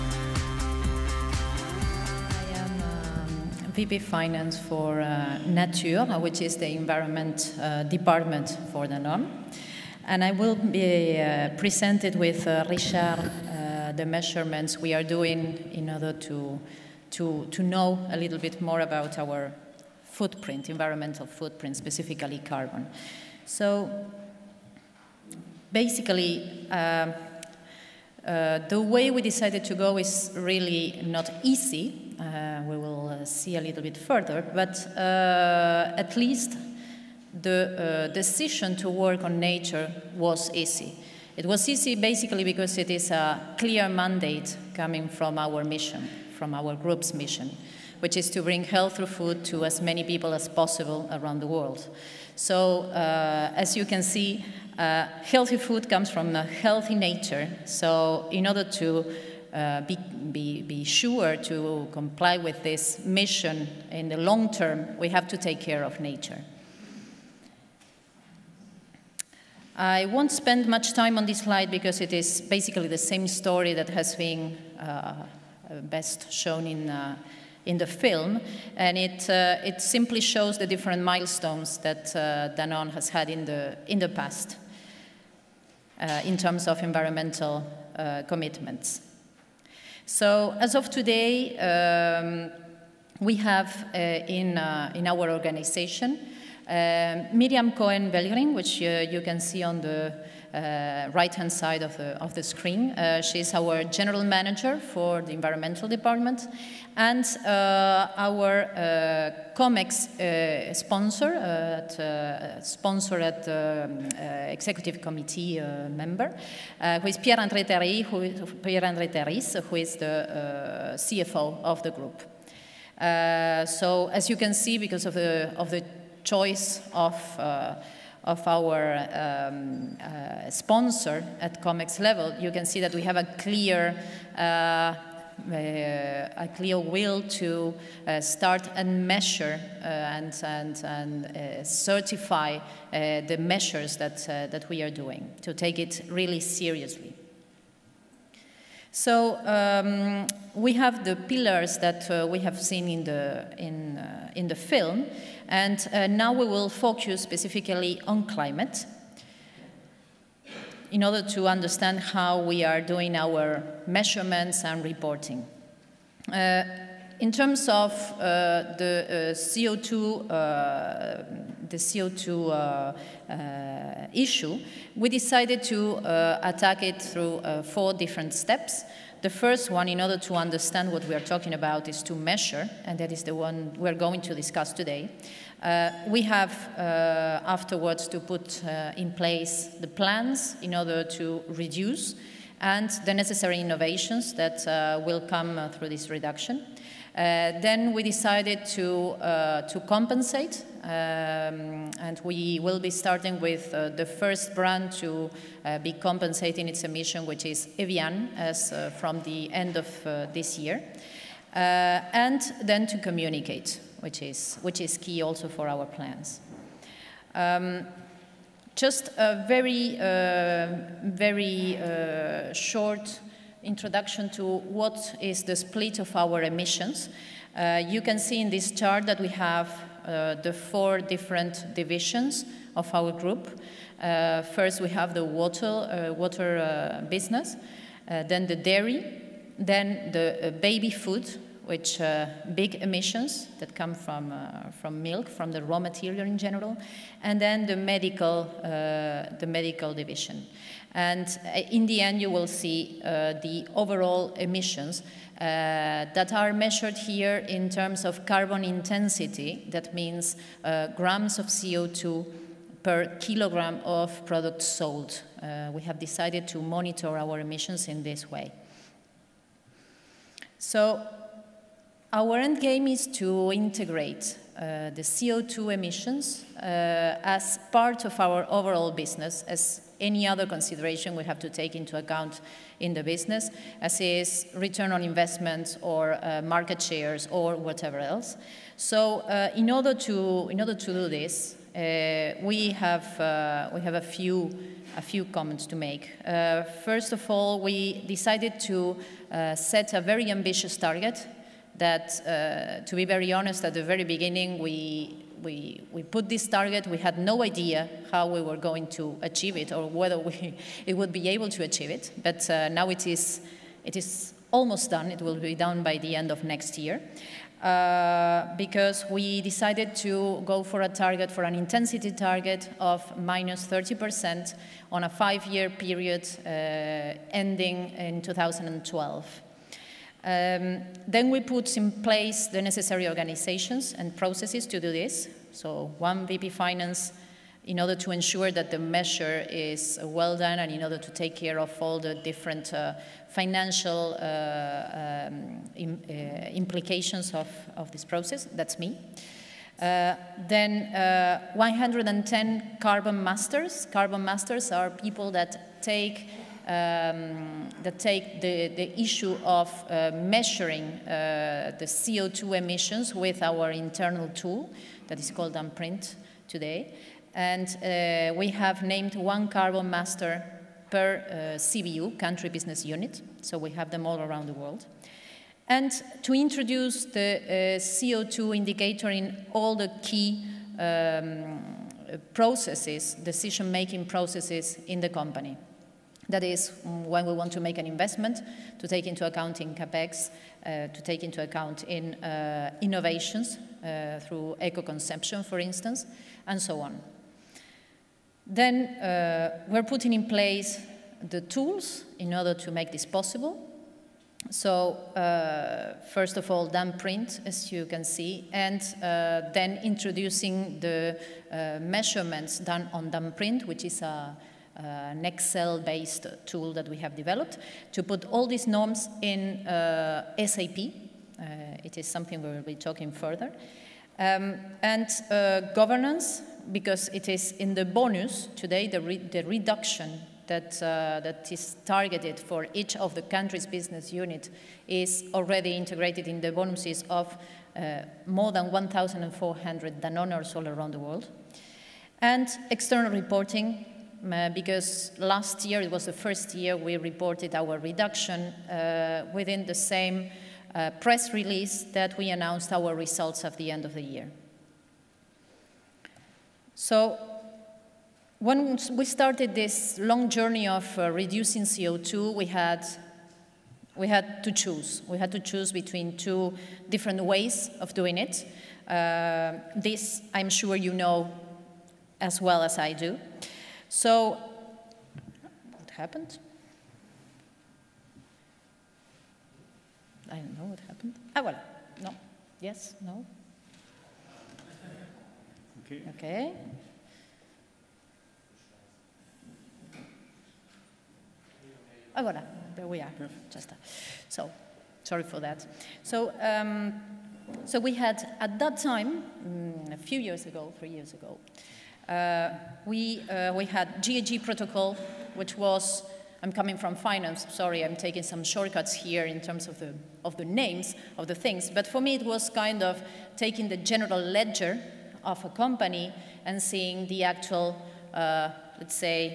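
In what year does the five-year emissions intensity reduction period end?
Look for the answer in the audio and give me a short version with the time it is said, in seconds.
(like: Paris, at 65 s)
2012, at 328 s.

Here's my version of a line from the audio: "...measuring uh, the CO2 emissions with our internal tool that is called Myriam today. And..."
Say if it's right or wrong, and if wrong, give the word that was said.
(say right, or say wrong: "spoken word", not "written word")
wrong: "DanPrint", not "Myriam".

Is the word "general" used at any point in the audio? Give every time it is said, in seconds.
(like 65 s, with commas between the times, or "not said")
103 s, 246 s, 513 s.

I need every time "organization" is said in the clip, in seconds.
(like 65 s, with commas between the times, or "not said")
95 s, 333 s.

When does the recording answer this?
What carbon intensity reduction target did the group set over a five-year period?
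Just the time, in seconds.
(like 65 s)
323 s.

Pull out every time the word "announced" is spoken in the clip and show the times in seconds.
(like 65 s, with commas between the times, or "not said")
452 s.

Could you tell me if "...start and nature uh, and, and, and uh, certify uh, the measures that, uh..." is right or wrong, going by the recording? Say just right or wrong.
wrong.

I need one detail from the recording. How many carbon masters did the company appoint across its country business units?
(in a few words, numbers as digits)
110.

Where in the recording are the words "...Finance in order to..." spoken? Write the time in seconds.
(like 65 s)
336 s.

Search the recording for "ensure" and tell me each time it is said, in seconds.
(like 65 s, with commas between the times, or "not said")
338 s.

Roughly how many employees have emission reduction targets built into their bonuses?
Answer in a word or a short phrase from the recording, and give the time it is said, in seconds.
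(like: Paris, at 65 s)
more than 1,400, at 438 s.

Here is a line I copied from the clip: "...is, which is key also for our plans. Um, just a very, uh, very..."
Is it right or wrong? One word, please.
right.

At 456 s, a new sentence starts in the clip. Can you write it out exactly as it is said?
So when we started this long journey of uh, reducing CO2, we had, we had to choose.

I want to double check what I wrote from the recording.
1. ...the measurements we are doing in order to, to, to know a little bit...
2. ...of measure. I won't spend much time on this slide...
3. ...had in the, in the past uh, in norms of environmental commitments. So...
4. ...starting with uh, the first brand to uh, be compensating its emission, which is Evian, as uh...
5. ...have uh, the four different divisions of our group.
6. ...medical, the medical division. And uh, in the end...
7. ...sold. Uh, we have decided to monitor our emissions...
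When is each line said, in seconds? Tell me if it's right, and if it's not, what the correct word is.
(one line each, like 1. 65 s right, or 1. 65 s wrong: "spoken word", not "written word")
1. 13 s right
2. 65 s wrong: "nature", not "measure"
3. 83 s wrong: "terms", not "norms"
4. 202 s right
5. 229 s right
6. 247 s right
7. 264 s right.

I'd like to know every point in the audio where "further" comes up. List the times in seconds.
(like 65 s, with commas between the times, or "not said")
33 s, 423 s.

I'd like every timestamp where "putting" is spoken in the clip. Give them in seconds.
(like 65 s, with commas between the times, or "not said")
399 s.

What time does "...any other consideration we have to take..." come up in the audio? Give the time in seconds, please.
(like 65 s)
279 s.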